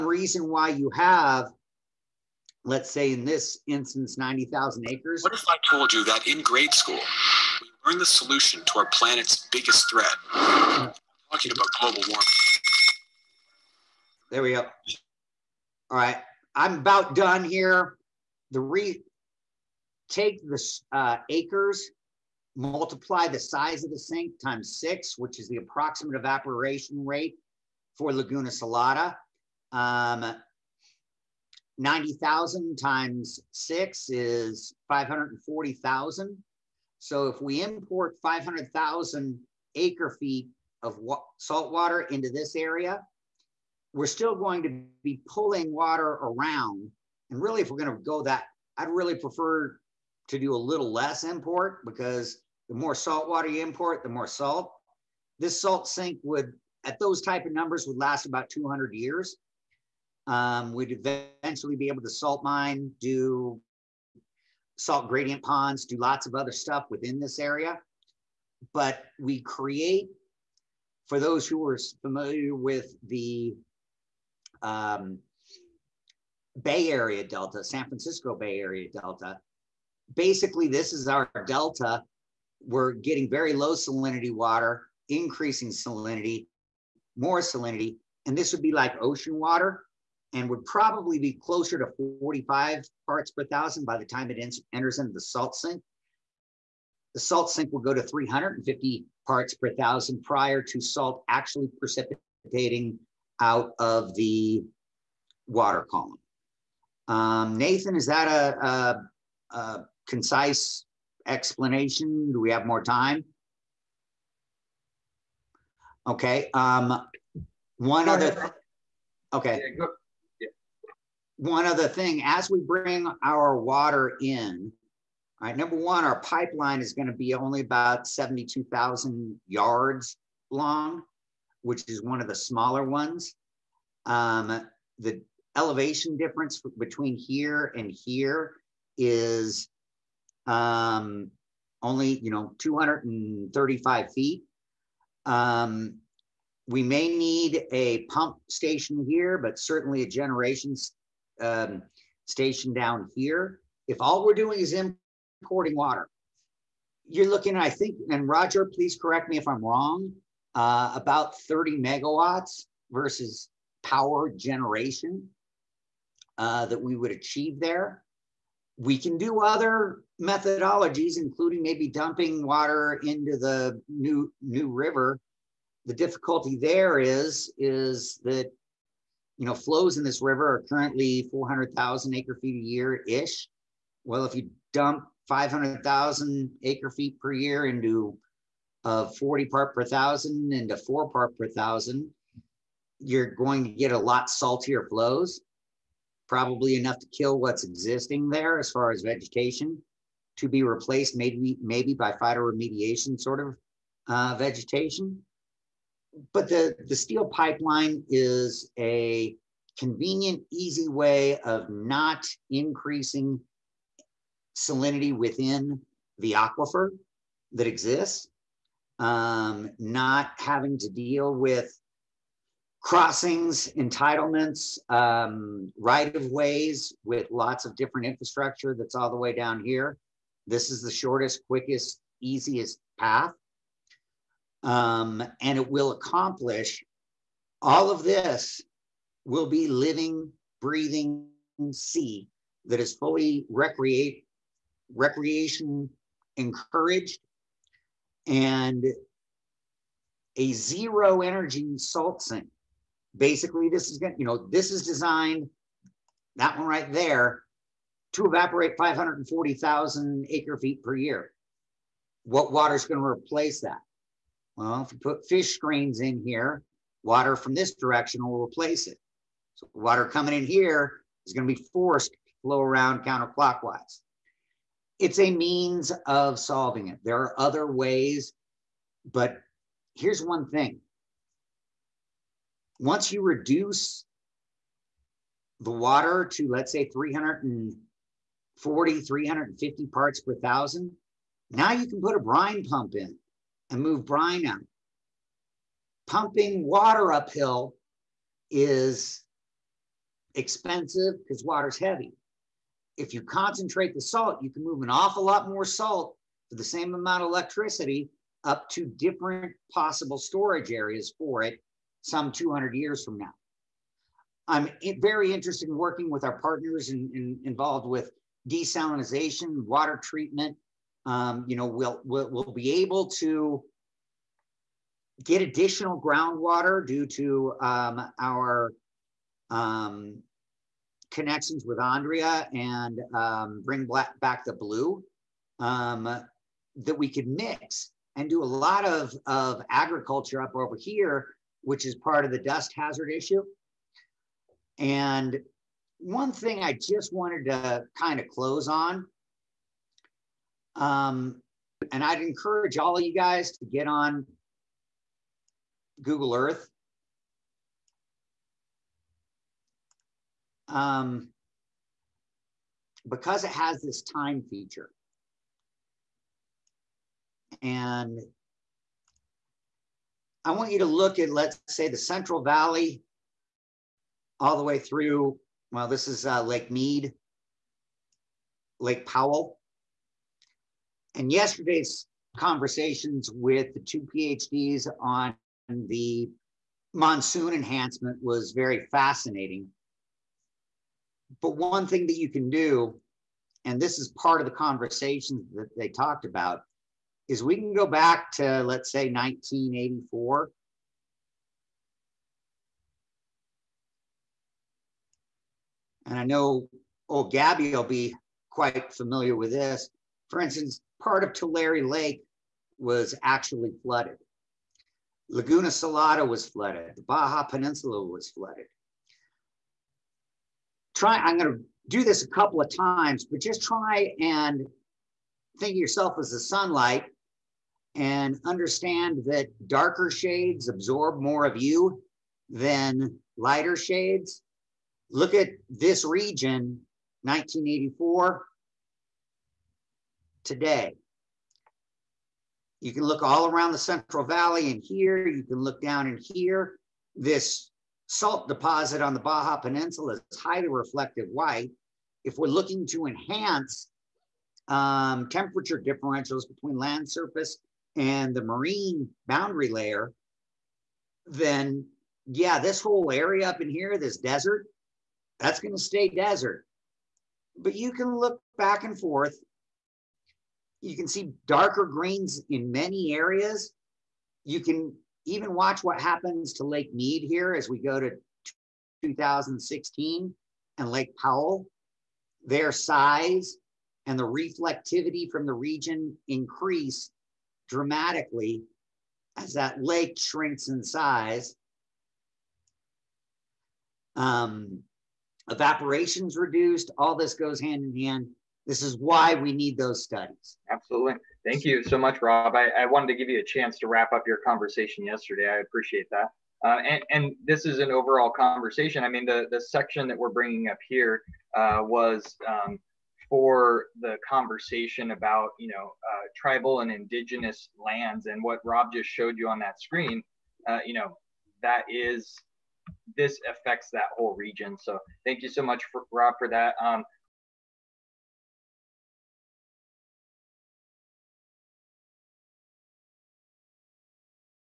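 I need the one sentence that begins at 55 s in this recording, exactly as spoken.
This salt sink would, at those type of numbers, would last about 200 years.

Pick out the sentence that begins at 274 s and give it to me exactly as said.
It's a means of solving it.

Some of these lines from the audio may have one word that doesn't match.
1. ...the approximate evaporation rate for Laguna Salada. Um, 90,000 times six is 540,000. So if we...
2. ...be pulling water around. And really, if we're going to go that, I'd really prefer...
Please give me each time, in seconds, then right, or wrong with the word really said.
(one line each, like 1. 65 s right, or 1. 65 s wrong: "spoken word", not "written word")
1. 25 s right
2. 45 s right.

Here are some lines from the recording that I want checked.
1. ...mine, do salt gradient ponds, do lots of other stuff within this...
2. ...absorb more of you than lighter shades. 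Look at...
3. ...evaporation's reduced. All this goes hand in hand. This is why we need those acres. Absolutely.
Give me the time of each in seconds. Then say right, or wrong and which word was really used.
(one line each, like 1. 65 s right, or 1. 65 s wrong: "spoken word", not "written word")
1. 62 s right
2. 430 s right
3. 495 s wrong: "studies", not "acres".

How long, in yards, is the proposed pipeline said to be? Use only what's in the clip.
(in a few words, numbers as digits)
72,000 yards.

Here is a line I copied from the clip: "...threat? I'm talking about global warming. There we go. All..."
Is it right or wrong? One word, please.
right.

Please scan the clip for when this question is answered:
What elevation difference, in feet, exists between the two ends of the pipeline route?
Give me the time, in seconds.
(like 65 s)
142 s.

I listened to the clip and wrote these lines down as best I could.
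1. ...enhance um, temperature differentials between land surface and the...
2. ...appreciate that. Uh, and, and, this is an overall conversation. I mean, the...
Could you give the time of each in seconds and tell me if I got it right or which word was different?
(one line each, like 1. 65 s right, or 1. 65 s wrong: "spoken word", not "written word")
1. 453 s right
2. 505 s right.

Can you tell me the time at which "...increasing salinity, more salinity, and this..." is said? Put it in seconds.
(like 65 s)
85 s.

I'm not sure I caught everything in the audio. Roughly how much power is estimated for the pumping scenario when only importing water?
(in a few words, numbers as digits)
30 megawatts.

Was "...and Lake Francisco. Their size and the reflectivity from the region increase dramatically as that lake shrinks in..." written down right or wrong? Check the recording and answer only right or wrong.
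wrong.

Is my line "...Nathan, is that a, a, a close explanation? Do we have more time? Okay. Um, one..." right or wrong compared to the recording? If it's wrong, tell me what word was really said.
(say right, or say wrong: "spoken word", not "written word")
wrong: "concise", not "close".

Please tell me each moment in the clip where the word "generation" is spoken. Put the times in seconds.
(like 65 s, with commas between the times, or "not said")
150 s, 164 s.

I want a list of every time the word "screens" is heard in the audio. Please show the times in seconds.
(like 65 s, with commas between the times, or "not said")
265 s, 519 s.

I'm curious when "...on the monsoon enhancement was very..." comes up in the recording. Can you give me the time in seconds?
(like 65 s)
384 s.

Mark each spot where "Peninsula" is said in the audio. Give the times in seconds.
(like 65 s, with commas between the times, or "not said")
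417 s, 449 s.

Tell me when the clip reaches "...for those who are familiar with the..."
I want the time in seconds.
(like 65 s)
71 s.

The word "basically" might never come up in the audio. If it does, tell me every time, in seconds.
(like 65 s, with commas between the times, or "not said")
80 s, 253 s.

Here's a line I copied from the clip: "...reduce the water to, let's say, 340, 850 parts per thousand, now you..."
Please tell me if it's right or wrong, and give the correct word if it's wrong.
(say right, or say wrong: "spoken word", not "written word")
wrong: "350", not "850".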